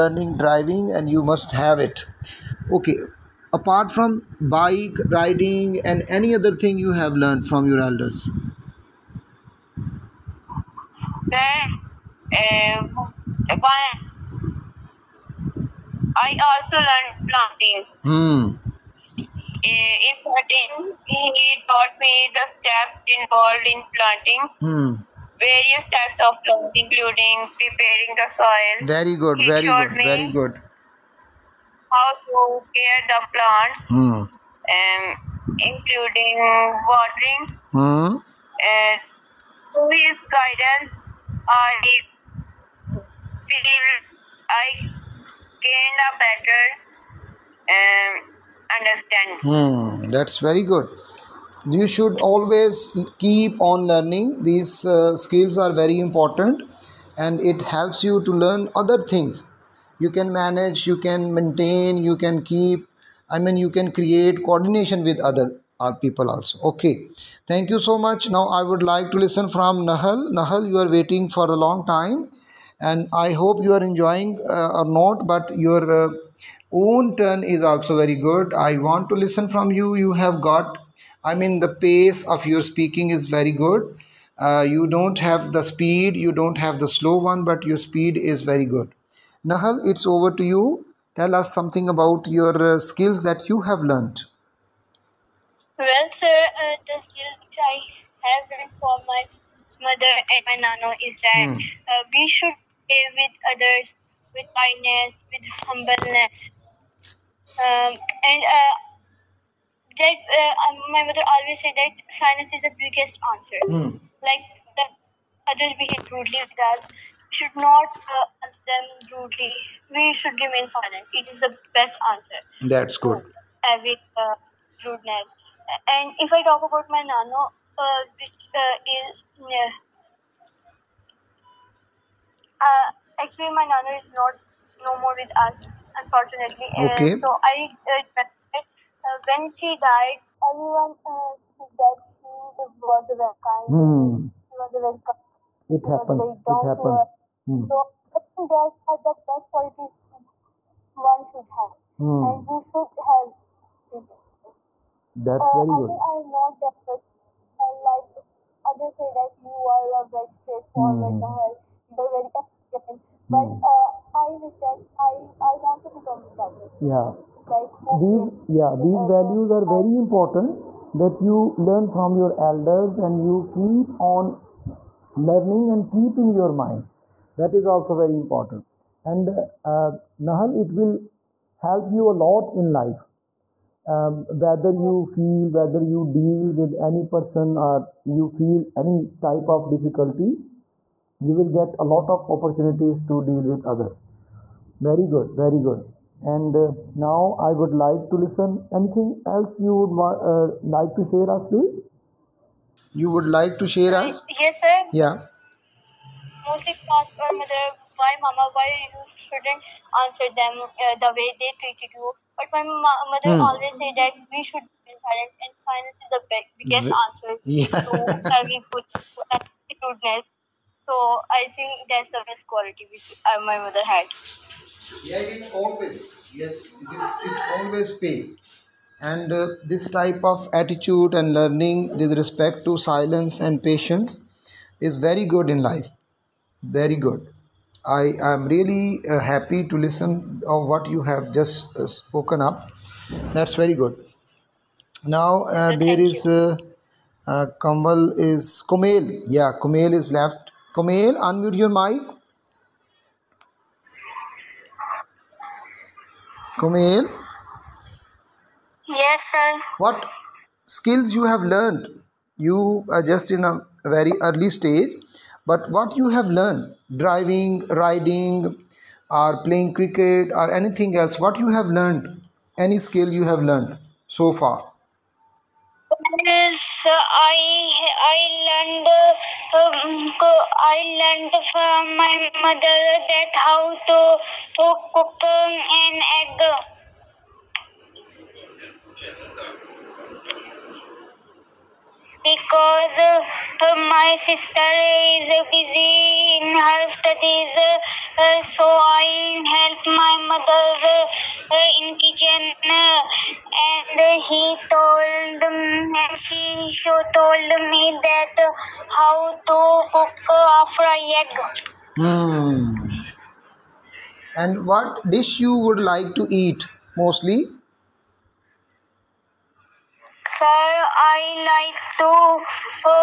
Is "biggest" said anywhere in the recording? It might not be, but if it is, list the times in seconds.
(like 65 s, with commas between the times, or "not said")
112 s, 216 s.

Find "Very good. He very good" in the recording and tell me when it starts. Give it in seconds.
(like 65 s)
28 s.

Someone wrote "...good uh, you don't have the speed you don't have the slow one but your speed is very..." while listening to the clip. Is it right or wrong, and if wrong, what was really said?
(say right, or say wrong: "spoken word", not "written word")
right.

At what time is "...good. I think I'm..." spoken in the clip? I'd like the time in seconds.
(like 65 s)
155 s.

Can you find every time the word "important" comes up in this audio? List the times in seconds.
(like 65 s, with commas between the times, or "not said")
55 s, 169 s, 178 s.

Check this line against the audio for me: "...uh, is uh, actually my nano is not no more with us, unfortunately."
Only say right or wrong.
right.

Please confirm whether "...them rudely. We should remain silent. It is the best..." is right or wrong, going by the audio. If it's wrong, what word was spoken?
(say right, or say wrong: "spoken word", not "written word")
right.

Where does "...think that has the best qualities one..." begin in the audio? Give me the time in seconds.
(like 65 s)
148 s.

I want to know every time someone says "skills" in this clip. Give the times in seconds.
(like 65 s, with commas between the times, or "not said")
55 s, 92 s, 97 s, 260 s, 272 s.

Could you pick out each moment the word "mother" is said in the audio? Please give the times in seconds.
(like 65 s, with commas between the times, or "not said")
99 s, 111 s, 207 s, 212 s, 223 s, 282 s, 300 s.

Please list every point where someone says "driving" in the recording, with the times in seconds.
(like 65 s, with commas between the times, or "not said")
0 s, 266 s.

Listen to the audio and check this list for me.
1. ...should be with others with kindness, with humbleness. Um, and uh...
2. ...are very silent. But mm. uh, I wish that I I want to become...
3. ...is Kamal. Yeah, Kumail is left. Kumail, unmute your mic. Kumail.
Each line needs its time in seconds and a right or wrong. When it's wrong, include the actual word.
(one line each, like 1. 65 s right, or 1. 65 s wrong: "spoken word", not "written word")
1. 102 s right
2. 162 s wrong: "elegant", not "silent"
3. 248 s wrong: "Kumail", not "Kamal".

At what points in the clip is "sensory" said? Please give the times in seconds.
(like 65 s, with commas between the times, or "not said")
not said.